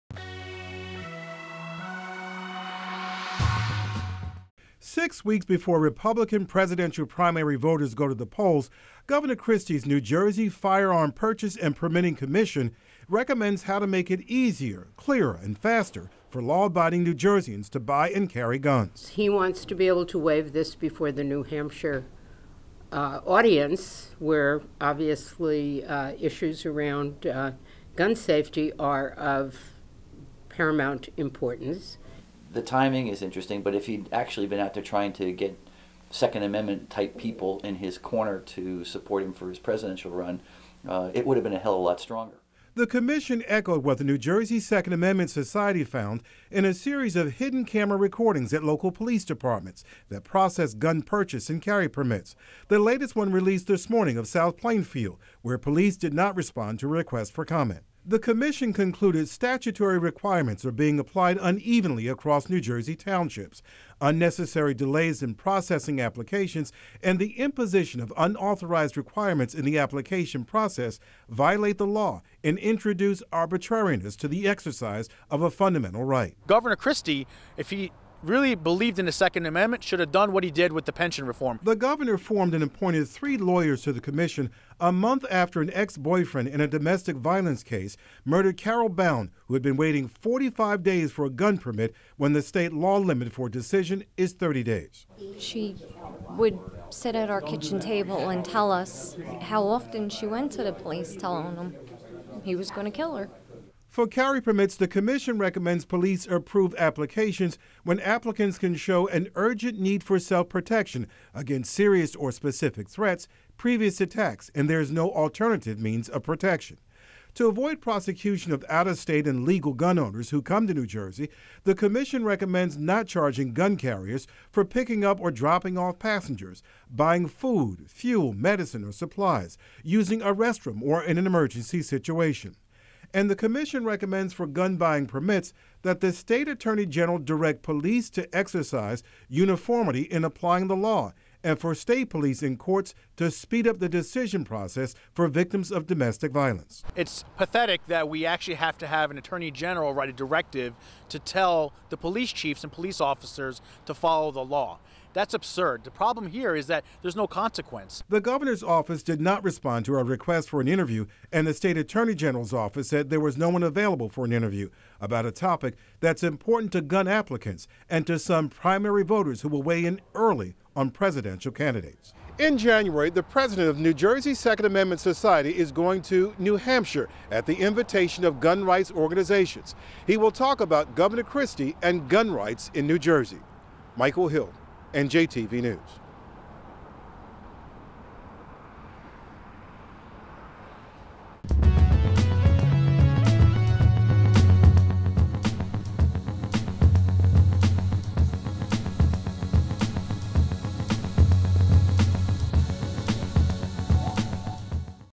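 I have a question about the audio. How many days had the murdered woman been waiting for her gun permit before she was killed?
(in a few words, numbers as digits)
45.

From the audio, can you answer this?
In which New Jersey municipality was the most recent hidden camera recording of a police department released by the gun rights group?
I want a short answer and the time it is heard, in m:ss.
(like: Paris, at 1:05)
South Plainfield, at 0:54.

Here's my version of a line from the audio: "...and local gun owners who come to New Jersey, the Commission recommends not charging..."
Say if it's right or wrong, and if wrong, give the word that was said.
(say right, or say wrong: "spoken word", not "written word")
wrong: "legal", not "local".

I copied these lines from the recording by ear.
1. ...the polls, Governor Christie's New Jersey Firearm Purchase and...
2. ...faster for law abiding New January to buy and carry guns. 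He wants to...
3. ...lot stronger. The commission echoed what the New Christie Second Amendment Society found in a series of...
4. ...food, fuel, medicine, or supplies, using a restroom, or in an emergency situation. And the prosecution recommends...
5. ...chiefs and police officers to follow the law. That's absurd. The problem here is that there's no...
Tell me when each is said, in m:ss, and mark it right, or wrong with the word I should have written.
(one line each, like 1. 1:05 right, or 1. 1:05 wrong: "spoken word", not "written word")
1. 0:08 right
2. 0:15 wrong: "Jerseyans", not "January"
3. 0:41 wrong: "Jersey", not "Christie"
4. 2:07 wrong: "commission", not "prosecution"
5. 2:32 right.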